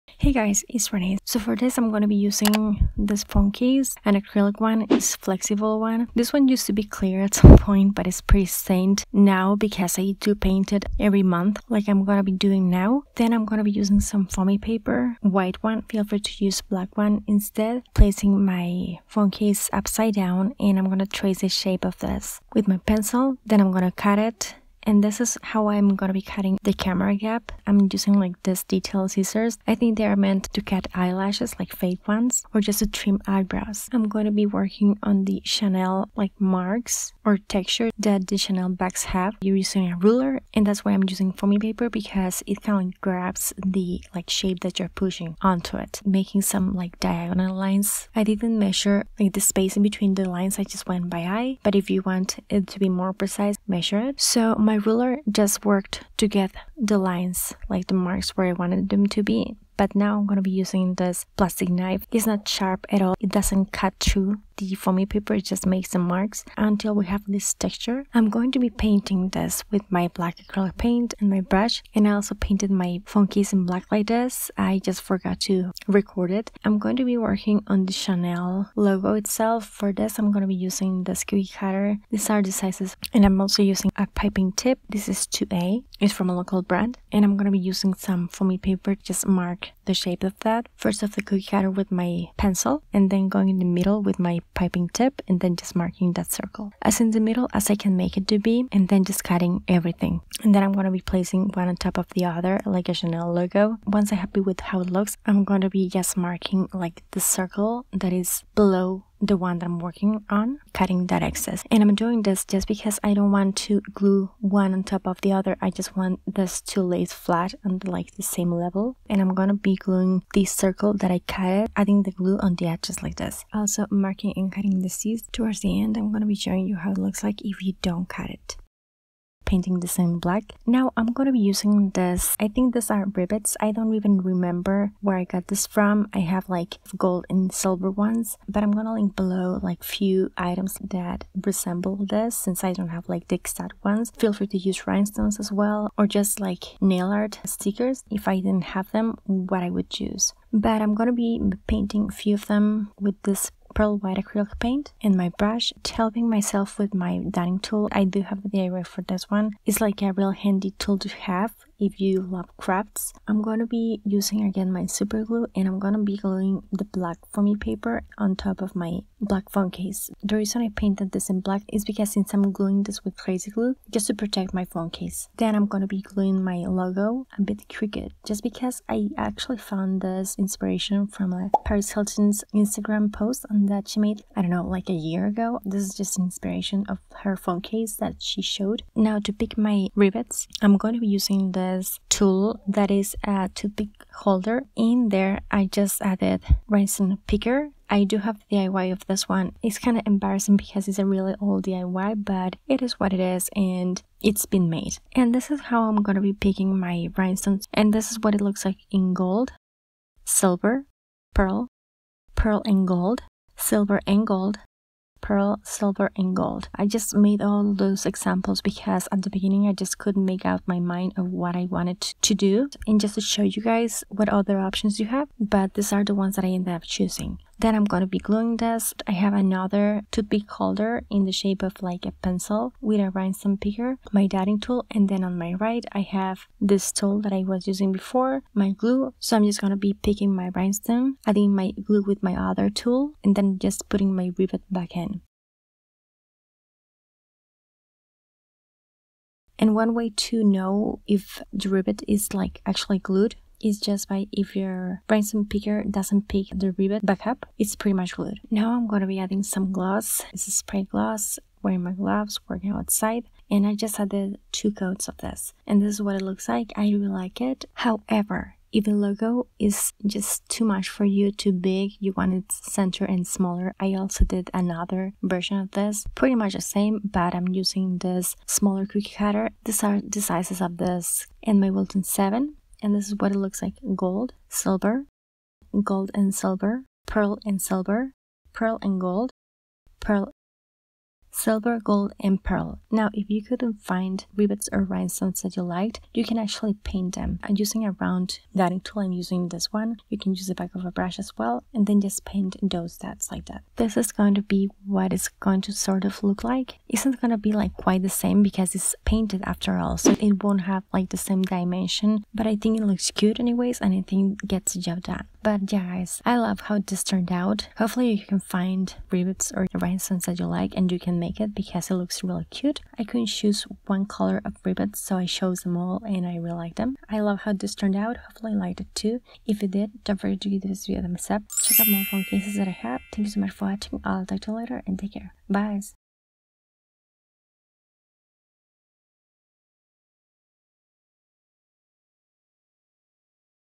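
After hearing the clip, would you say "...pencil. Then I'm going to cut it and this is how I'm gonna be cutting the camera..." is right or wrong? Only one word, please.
right.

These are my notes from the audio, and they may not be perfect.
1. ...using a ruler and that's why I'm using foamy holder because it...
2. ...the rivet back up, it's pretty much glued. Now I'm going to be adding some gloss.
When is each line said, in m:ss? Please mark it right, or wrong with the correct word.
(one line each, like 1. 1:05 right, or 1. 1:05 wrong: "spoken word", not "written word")
1. 0:39 wrong: "paper", not "holder"
2. 4:16 right.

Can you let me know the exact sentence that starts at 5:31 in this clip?
Check out more phone cases that I have.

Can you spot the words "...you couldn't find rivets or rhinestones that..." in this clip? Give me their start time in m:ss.
4:53.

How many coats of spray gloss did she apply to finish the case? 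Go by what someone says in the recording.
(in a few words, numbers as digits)
2.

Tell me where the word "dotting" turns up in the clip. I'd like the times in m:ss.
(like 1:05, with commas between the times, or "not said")
2:37, 3:54, 4:58.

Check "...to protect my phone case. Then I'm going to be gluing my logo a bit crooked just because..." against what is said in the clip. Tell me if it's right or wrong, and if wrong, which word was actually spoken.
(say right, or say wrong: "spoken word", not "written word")
right.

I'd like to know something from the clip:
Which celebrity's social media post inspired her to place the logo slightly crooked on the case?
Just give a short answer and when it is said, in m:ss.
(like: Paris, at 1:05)
Paris Hilton, at 3:01.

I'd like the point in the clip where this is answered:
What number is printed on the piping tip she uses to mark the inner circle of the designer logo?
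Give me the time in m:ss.
1:25.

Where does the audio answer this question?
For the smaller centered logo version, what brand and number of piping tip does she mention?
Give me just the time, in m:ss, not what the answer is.
4:41.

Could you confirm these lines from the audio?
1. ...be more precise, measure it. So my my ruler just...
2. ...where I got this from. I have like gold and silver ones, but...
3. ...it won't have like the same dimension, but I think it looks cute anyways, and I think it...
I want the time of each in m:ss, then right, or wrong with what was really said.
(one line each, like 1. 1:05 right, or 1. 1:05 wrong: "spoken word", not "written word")
1. 0:52 right
2. 2:15 right
3. 5:10 right.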